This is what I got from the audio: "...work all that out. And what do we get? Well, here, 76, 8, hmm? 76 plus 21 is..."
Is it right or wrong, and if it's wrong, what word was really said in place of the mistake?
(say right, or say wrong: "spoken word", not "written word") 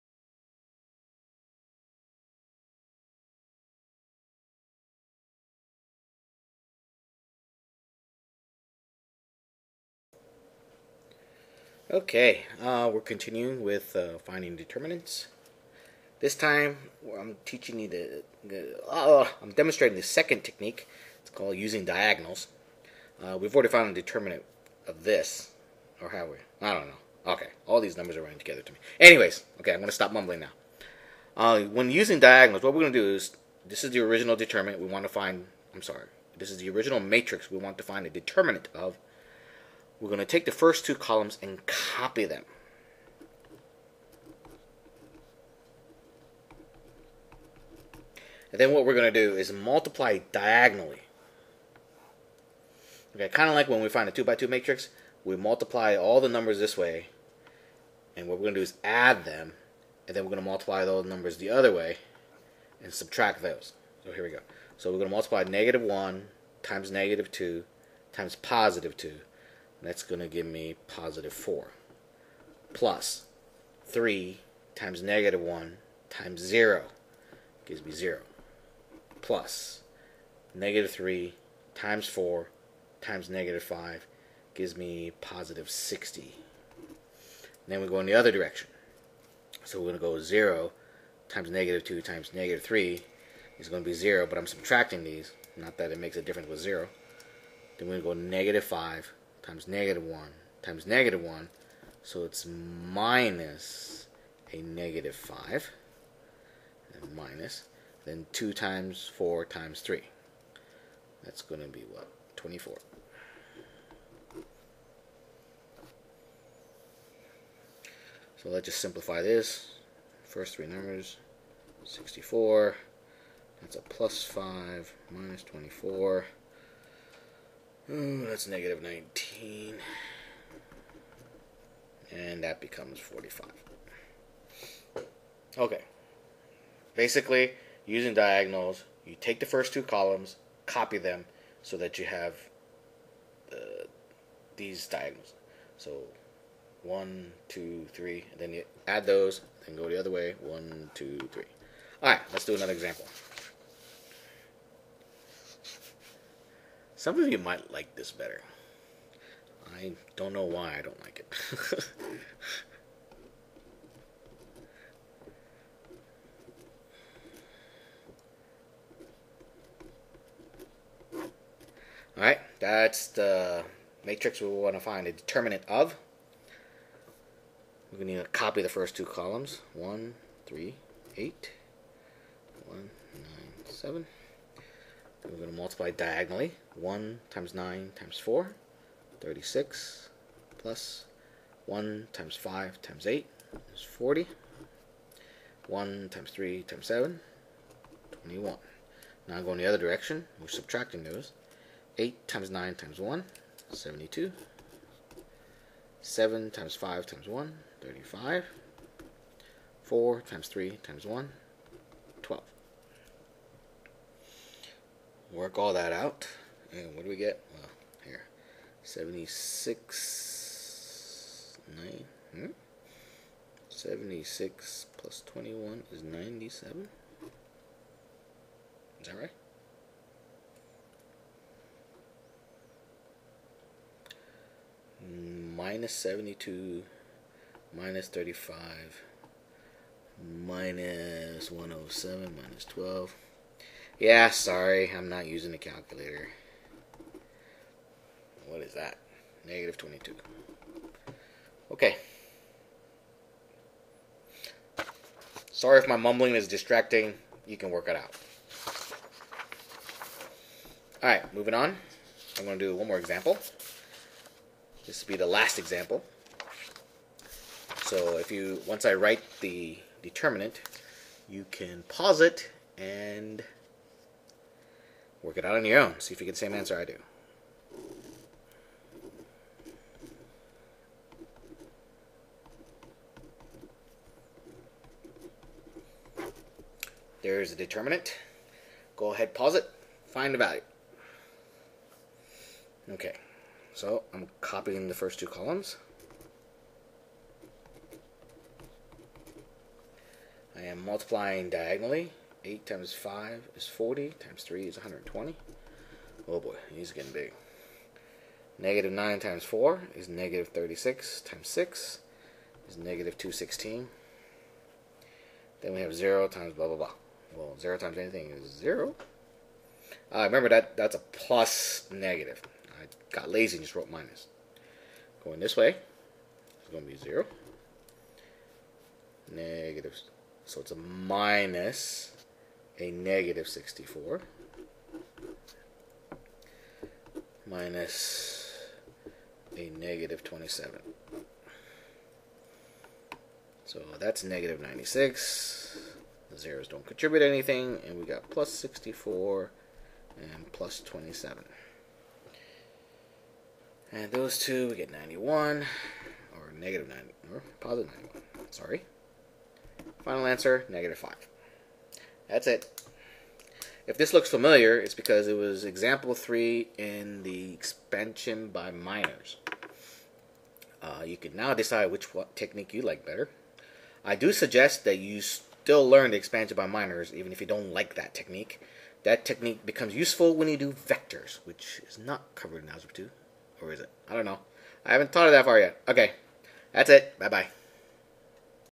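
wrong: "9", not "8".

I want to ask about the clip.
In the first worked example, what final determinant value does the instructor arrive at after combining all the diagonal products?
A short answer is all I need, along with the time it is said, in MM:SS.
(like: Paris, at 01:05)
45, at 02:12.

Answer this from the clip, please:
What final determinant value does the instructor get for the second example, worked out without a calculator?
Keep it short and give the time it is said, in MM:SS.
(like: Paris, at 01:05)
-22, at 04:09.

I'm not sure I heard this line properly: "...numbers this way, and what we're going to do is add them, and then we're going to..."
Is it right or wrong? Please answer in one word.
right.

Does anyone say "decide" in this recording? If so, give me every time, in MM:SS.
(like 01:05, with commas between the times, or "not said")
06:11.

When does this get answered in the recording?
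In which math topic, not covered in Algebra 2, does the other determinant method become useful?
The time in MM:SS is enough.
06:20.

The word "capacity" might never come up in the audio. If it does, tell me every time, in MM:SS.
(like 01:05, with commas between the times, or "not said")
not said.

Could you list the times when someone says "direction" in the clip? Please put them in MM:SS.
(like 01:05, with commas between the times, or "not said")
01:28, 03:19.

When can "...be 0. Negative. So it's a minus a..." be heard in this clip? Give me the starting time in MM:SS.
05:26.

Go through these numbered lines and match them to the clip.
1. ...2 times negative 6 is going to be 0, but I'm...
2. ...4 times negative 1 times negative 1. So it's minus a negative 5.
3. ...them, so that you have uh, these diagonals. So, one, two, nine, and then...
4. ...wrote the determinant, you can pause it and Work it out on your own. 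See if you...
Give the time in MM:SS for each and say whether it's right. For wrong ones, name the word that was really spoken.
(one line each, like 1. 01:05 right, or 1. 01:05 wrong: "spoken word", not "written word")
1. 01:31 wrong: "3", not "6"
2. 01:38 wrong: "5", not "4"
3. 02:20 wrong: "three", not "nine"
4. 04:28 wrong: "write", not "wrote".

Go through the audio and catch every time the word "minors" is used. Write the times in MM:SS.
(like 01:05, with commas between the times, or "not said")
06:08, 06:16.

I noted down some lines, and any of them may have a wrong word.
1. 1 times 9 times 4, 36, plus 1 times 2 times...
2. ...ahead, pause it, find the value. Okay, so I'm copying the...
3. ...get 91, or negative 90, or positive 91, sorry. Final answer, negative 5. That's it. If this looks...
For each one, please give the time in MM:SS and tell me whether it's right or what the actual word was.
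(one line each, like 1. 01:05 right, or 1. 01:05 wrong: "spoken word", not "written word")
1. 03:06 wrong: "5", not "2"
2. 04:49 right
3. 05:54 right.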